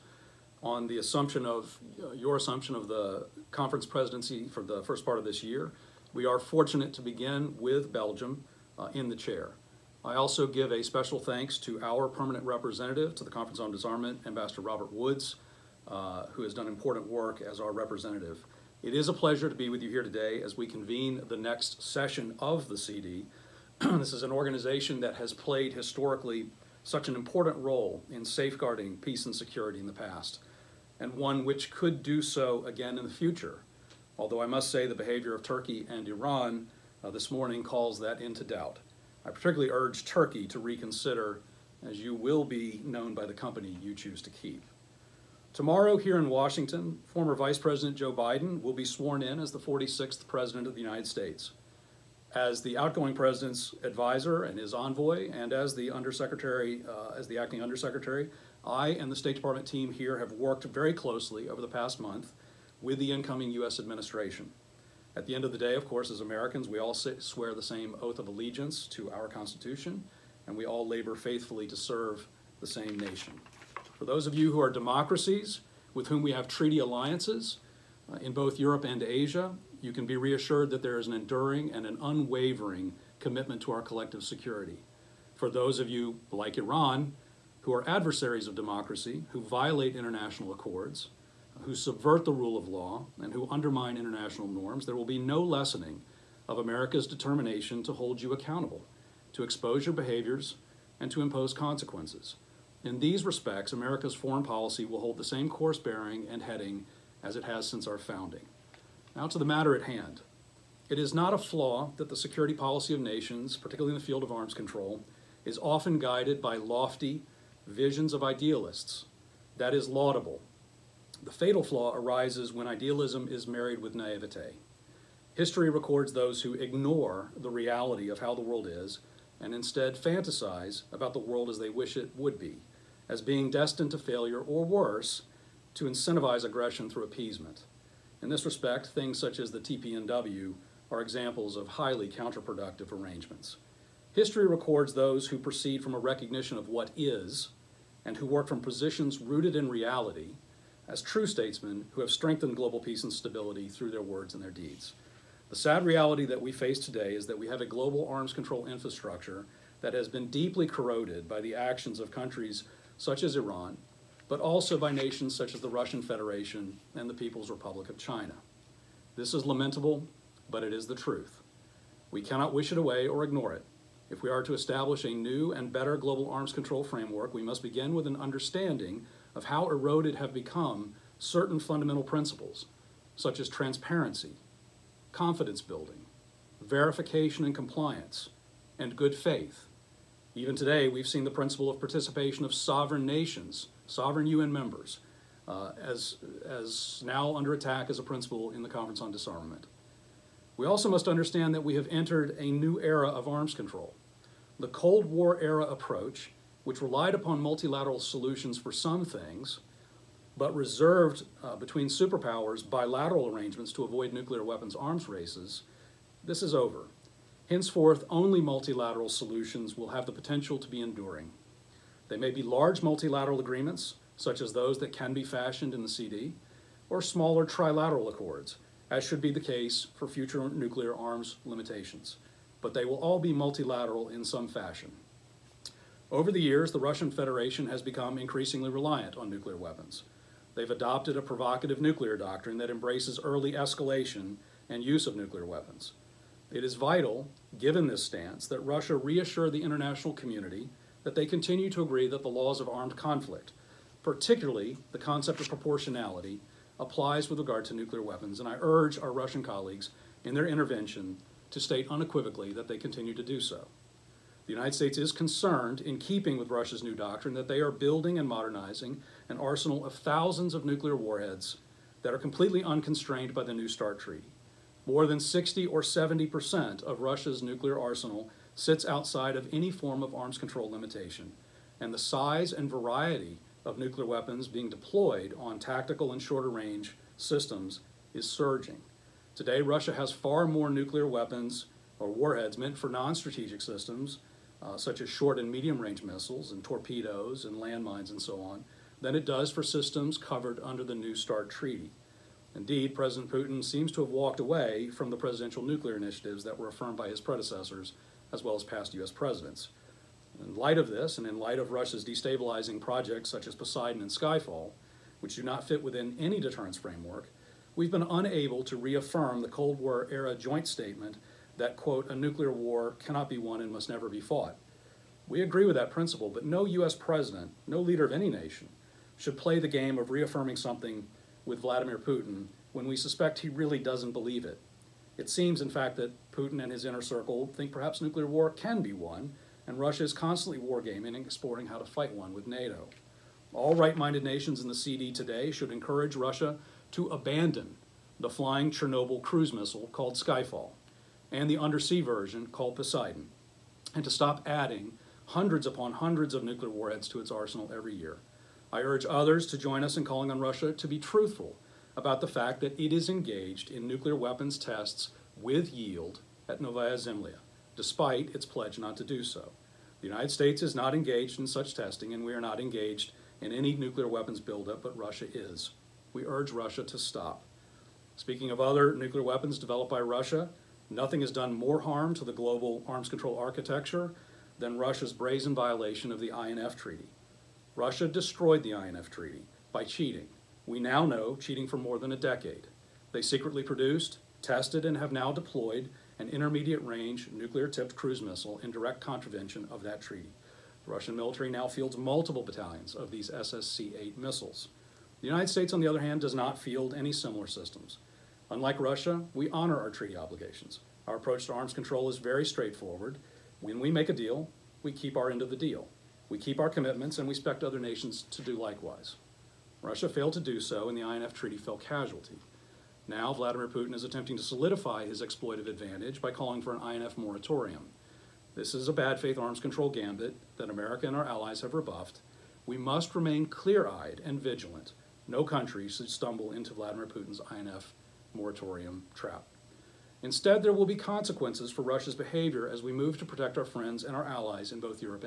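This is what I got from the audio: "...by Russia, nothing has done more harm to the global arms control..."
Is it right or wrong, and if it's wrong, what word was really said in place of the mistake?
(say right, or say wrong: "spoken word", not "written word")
right.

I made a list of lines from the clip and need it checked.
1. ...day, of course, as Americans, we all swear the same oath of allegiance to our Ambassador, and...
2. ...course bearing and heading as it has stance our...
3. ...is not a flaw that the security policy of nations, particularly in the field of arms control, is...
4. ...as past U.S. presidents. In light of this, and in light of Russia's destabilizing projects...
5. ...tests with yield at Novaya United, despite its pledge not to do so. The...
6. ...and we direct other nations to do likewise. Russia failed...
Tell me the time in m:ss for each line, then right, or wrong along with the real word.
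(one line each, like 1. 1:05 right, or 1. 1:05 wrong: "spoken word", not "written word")
1. 1:05 wrong: "Constitution", not "Ambassador"
2. 1:45 wrong: "since", not "stance"
3. 1:50 right
4. 5:08 right
5. 6:04 wrong: "Zemlya", not "United"
6. 6:57 wrong: "expect", not "direct".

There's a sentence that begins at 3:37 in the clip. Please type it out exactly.
Henceforth, only multilateral solutions will have the potential to be enduring.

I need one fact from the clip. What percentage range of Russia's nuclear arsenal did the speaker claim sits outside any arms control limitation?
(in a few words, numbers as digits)
60 or 70%.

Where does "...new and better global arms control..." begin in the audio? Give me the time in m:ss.
2:55.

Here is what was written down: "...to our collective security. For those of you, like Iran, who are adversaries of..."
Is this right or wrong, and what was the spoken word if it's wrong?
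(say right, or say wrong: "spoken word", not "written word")
right.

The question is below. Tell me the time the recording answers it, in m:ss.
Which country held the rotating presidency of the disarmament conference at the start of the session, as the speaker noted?
0:07.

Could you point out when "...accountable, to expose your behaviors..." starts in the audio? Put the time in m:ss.
1:38.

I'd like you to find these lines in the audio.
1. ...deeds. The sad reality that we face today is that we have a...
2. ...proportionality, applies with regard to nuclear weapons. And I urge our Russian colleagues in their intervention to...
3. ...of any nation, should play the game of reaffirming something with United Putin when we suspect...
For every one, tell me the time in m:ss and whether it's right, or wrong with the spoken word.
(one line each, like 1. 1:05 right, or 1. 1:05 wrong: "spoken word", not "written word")
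1. 2:34 right
2. 4:15 right
3. 5:28 wrong: "Vladimir", not "United".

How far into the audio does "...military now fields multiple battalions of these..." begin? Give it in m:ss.
6:41.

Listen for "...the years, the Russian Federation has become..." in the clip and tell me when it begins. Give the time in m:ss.
3:56.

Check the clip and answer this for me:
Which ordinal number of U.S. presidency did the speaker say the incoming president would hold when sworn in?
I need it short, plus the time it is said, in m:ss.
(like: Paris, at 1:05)
46th, at 0:49.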